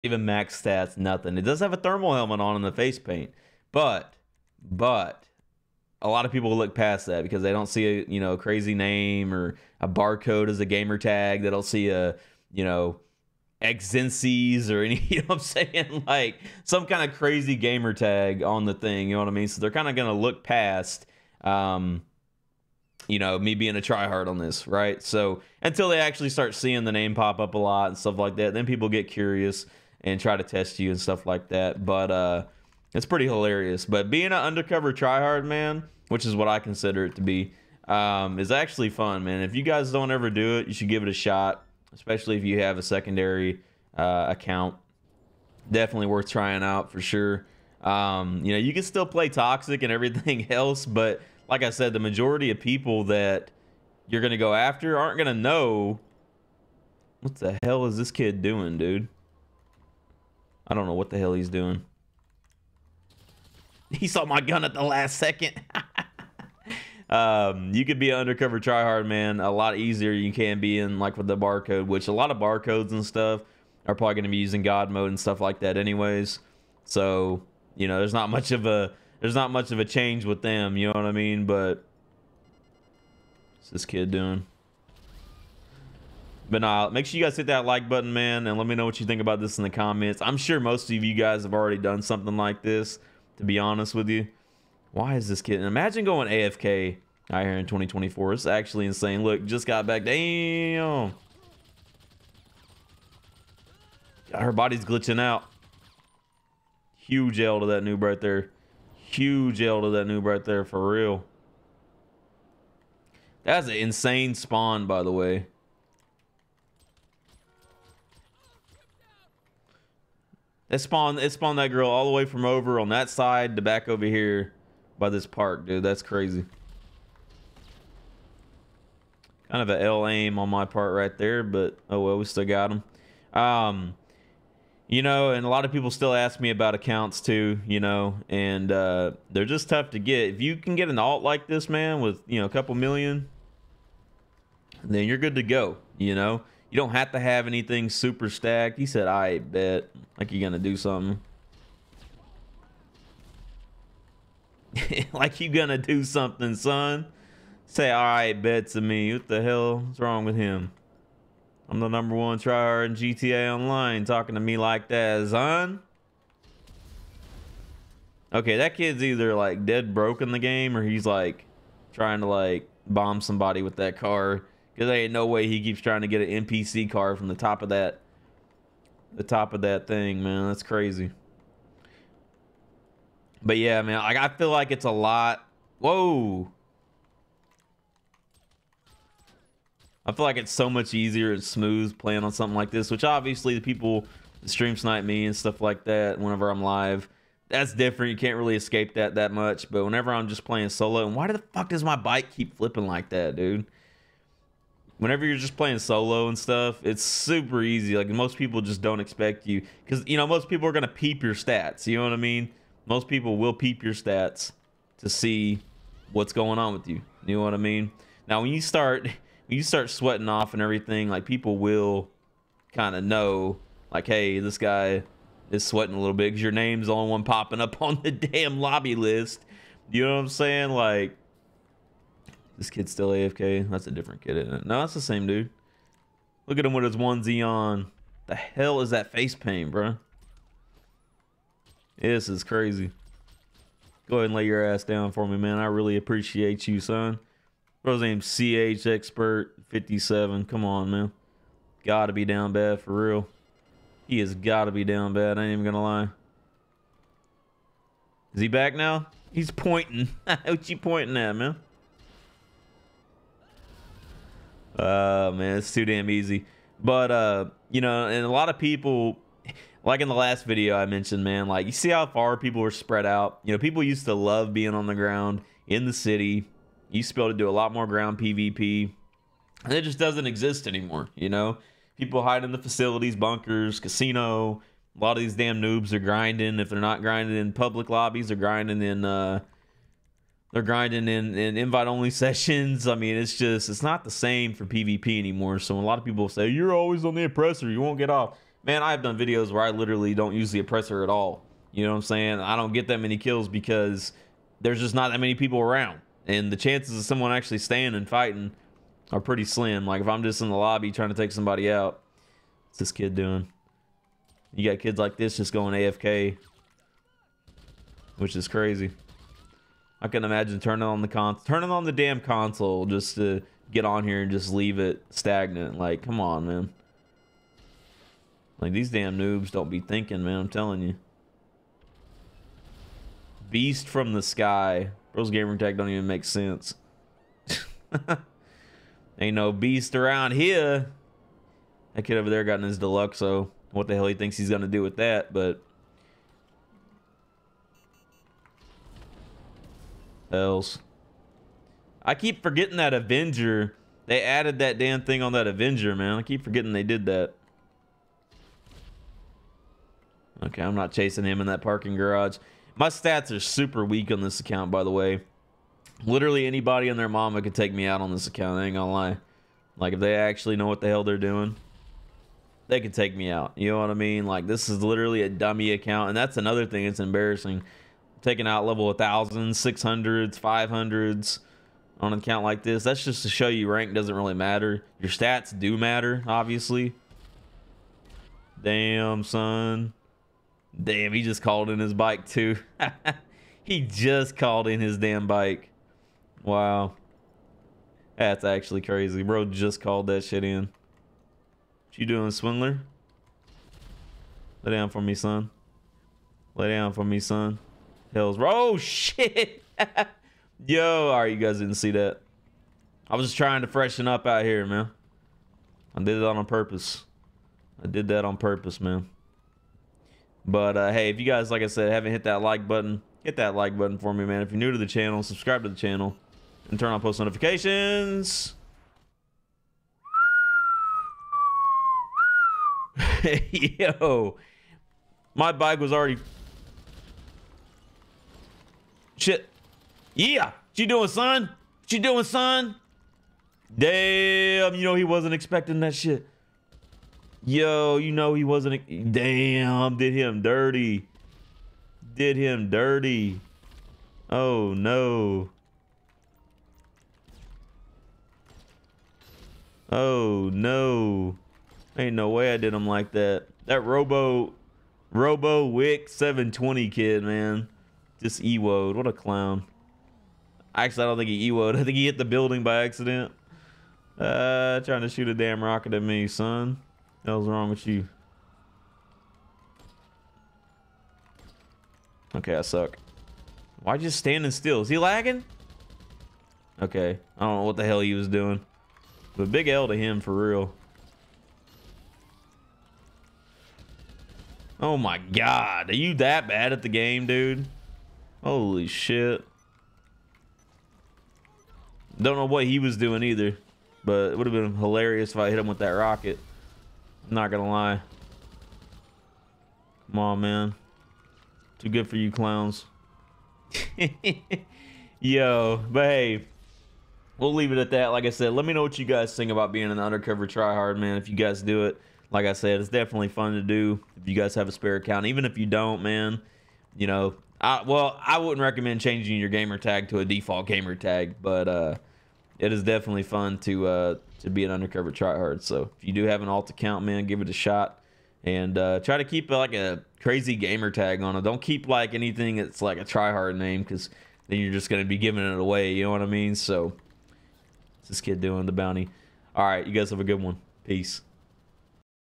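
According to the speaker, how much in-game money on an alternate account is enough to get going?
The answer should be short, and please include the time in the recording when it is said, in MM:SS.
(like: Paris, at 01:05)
a couple million, at 02:22.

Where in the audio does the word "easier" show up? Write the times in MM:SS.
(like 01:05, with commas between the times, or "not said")
01:09, 03:10.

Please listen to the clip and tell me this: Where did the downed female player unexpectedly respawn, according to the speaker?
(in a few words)
by this park.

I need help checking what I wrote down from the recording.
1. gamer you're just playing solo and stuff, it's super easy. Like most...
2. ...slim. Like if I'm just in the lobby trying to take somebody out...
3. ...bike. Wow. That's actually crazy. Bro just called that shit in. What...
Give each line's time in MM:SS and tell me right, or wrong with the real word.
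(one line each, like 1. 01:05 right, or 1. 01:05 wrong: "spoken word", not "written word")
1. 03:25 wrong: "whenever", not "gamer"
2. 05:09 right
3. 06:35 right.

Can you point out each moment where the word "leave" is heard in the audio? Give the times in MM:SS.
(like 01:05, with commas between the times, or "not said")
05:24, 08:37.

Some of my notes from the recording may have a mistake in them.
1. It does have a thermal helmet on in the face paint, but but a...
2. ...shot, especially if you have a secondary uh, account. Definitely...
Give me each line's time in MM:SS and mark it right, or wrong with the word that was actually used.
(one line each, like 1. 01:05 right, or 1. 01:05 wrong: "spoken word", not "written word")
1. 00:01 right
2. 00:41 right.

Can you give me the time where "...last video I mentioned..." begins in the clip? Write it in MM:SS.
04:30.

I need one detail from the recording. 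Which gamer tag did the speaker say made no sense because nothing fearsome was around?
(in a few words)
Beast from the sky.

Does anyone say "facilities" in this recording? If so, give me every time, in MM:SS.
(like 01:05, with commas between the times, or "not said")
04:42.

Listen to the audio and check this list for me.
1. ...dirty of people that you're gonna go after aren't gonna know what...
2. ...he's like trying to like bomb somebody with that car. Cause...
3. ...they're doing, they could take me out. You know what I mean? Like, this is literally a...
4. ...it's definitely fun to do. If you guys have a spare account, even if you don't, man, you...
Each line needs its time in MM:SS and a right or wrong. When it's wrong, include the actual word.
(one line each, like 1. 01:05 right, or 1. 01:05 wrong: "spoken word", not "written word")
1. 00:51 wrong: "majority", not "dirty"
2. 02:50 right
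3. 06:11 right
4. 08:42 right.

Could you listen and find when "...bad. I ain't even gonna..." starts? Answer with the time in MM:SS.
04:15.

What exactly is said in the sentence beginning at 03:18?
You can't really escape that that much.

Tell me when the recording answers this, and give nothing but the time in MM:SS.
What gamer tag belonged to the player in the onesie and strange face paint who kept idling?
04:08.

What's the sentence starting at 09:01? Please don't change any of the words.
Don't keep like anything that's like a tryhard name because then you're just gonna be giving it away.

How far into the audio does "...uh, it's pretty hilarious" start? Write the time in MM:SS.
00:32.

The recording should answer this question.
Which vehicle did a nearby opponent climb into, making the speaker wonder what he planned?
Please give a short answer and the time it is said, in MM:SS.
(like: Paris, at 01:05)
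Deluxo, at 05:42.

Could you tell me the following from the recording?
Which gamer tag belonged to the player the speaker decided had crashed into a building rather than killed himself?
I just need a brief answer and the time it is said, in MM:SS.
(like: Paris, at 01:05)
Robo Wick 720, at 07:45.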